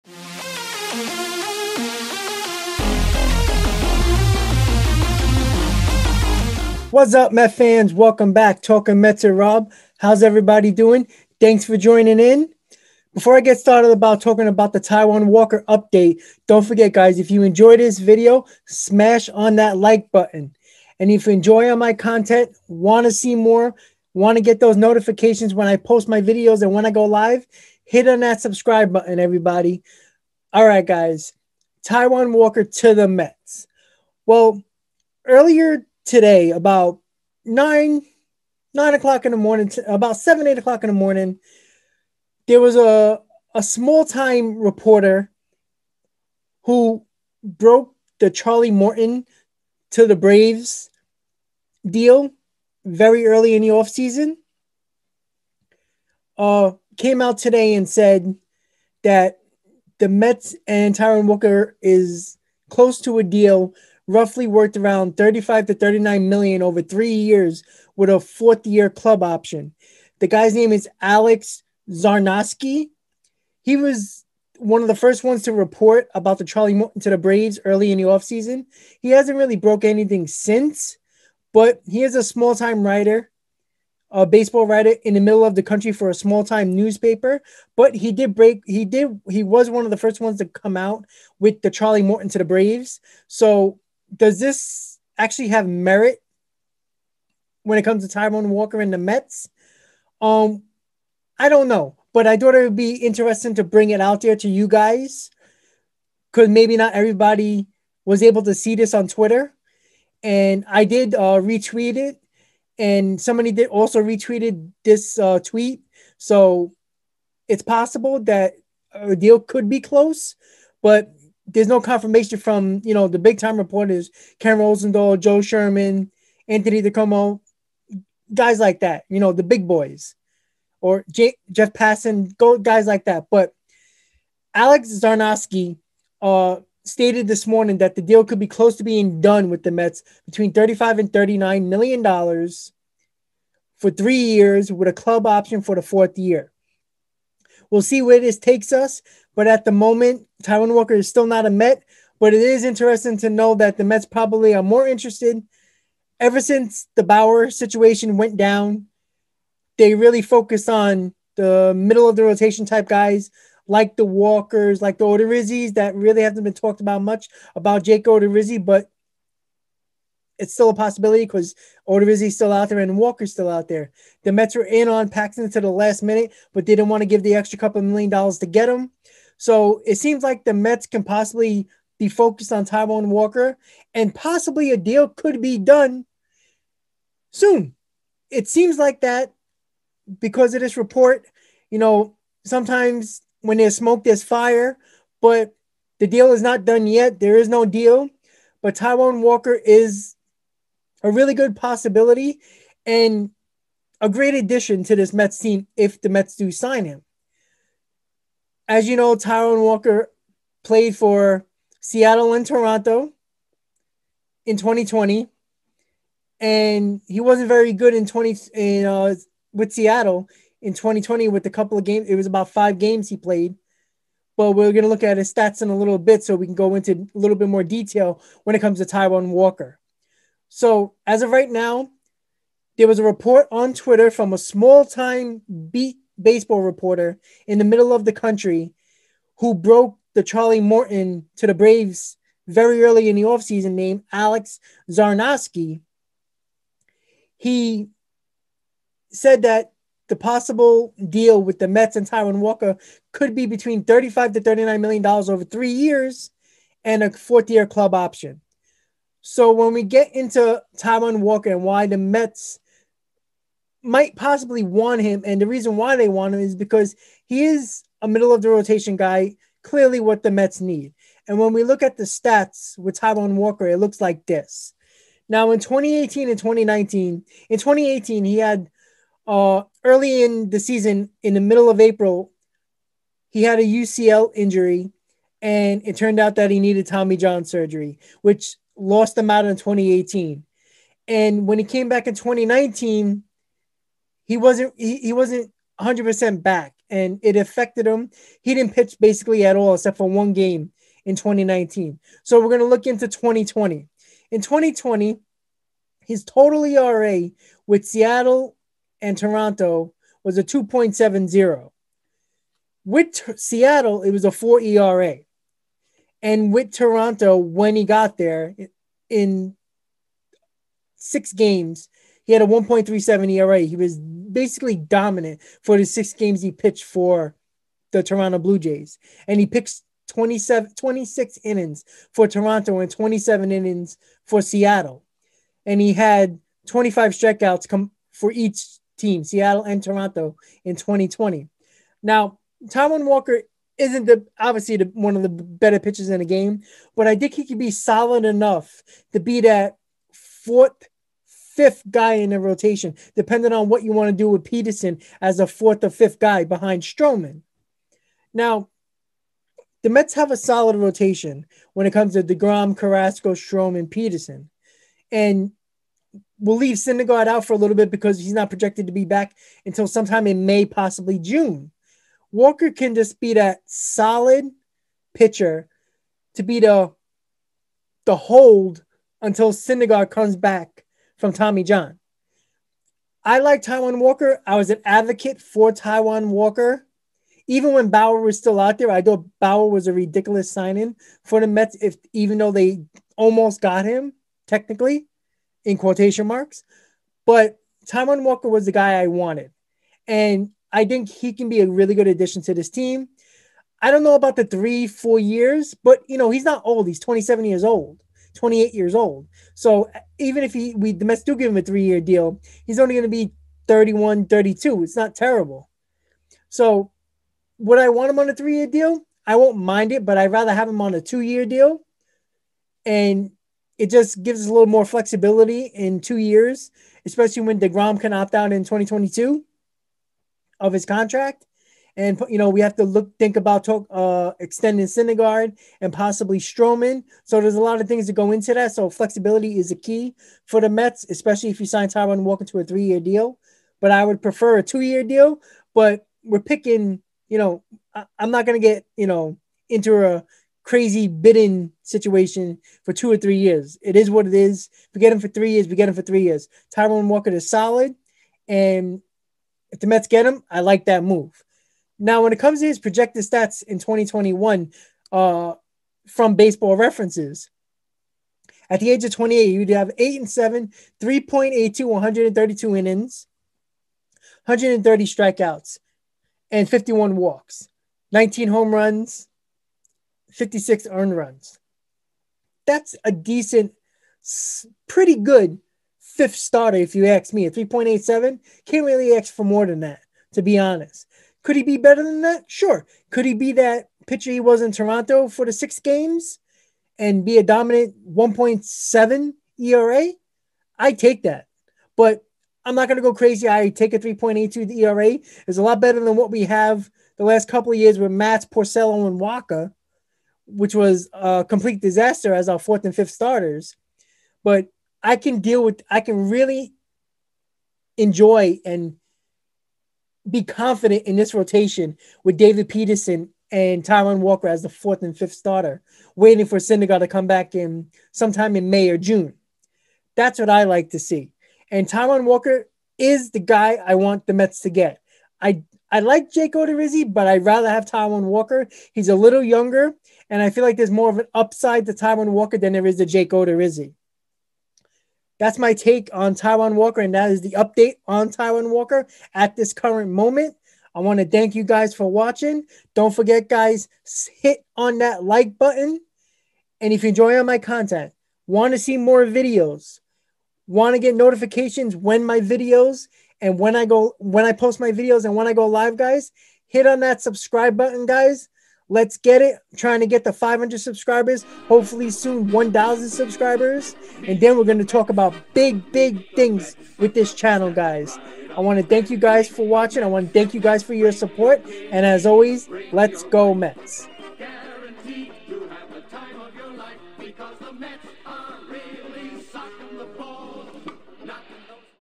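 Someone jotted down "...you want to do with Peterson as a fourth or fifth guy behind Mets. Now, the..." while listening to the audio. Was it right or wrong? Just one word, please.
wrong.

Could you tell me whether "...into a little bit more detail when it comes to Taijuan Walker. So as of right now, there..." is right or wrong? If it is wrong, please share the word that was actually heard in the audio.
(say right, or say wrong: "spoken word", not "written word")
right.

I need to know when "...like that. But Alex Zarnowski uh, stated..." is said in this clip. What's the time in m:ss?
2:12.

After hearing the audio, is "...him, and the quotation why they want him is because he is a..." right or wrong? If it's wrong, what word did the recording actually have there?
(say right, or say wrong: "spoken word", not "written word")
wrong: "reason", not "quotation".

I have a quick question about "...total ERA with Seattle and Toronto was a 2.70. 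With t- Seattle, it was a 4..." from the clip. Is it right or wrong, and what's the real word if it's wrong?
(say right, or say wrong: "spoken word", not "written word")
right.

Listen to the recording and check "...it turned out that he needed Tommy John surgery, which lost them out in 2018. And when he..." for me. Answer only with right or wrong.
right.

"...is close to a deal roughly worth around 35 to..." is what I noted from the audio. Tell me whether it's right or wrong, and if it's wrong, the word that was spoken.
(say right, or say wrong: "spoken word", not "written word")
right.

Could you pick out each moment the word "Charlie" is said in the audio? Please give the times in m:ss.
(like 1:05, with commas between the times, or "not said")
0:48, 1:16, 1:31, 4:00.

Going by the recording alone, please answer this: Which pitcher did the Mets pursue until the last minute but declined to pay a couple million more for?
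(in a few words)
Paxton.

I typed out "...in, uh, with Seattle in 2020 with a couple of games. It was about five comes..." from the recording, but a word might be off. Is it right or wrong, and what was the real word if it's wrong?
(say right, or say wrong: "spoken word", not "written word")
wrong: "games", not "comes".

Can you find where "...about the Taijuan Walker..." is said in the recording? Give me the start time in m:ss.
0:14.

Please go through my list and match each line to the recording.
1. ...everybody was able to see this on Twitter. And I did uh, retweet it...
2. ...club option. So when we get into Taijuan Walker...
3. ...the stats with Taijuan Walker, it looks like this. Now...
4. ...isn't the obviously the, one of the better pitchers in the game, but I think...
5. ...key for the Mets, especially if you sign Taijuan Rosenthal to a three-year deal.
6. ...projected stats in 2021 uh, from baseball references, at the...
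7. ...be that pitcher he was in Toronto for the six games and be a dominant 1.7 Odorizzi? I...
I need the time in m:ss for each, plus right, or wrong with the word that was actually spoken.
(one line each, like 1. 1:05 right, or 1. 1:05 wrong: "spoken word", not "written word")
1. 1:46 right
2. 4:17 right
3. 4:31 right
4. 5:43 right
5. 7:19 wrong: "Walker", not "Rosenthal"
6. 7:42 right
7. 8:13 wrong: "ERA", not "Odorizzi".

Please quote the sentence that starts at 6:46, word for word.
He's 27 years old, 28 years old.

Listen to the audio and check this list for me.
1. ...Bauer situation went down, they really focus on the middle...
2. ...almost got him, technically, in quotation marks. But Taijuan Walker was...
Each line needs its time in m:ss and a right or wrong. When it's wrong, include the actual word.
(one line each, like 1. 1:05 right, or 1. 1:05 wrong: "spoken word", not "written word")
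1. 2:37 right
2. 6:33 right.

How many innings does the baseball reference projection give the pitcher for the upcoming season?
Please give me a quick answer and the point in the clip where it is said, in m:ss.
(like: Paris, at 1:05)
132, at 7:51.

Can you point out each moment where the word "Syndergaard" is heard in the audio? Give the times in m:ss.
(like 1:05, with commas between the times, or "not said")
6:06, 6:19, 7:14, 8:46.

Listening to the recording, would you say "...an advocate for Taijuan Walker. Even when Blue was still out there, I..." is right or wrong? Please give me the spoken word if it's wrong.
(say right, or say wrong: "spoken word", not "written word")
wrong: "Bauer", not "Blue".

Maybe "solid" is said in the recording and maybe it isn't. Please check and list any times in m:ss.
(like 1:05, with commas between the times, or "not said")
5:47, 6:00, 6:13, 7:37.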